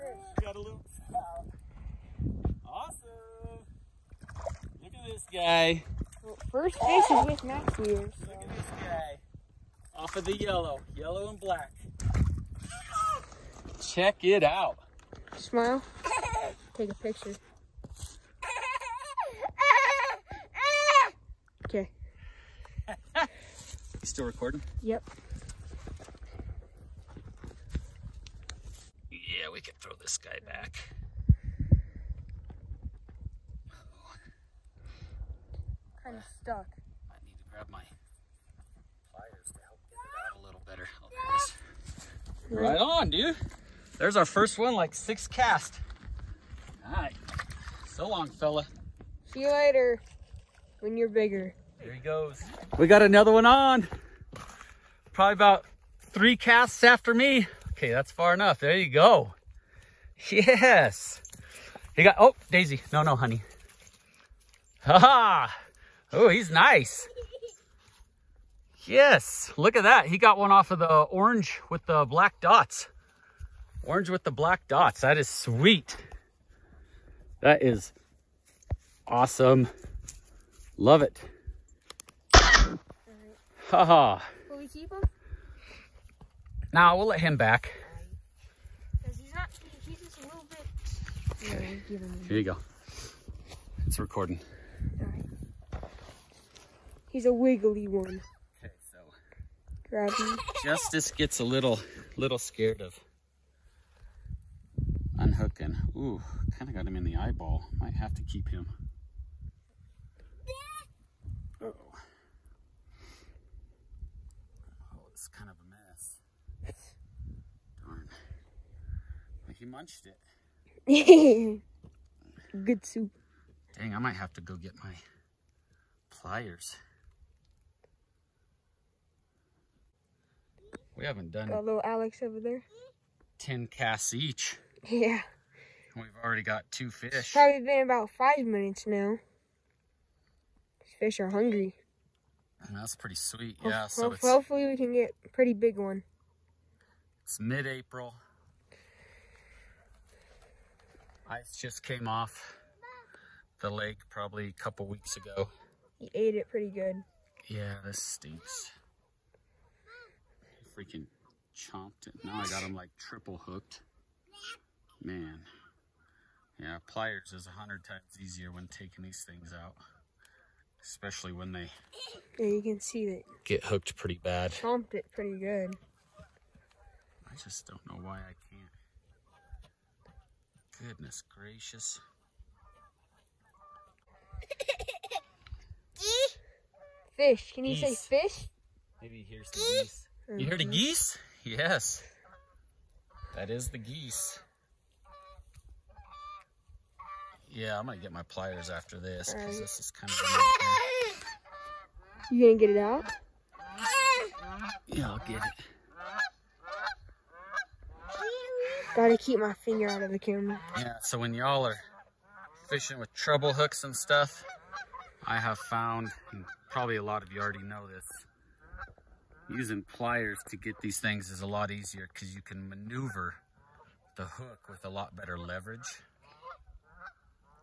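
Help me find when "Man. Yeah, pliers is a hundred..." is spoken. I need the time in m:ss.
2:45.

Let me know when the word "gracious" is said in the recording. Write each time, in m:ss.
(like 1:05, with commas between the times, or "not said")
3:01.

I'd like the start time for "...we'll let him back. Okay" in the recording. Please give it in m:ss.
1:26.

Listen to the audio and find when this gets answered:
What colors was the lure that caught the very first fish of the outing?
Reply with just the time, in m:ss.
0:10.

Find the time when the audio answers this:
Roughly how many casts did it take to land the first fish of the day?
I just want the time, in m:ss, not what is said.
0:44.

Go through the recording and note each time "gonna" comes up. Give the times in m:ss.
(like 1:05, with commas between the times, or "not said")
3:17, 3:22.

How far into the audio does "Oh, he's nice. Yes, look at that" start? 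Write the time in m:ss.
1:06.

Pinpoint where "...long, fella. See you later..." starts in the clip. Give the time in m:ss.
0:48.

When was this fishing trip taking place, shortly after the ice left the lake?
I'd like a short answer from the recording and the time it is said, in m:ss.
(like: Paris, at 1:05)
Mid-April, at 2:27.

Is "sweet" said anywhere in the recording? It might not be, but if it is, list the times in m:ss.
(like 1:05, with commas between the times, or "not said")
1:15, 2:23.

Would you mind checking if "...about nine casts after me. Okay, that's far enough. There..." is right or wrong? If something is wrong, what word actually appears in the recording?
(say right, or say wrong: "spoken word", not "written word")
wrong: "three", not "nine".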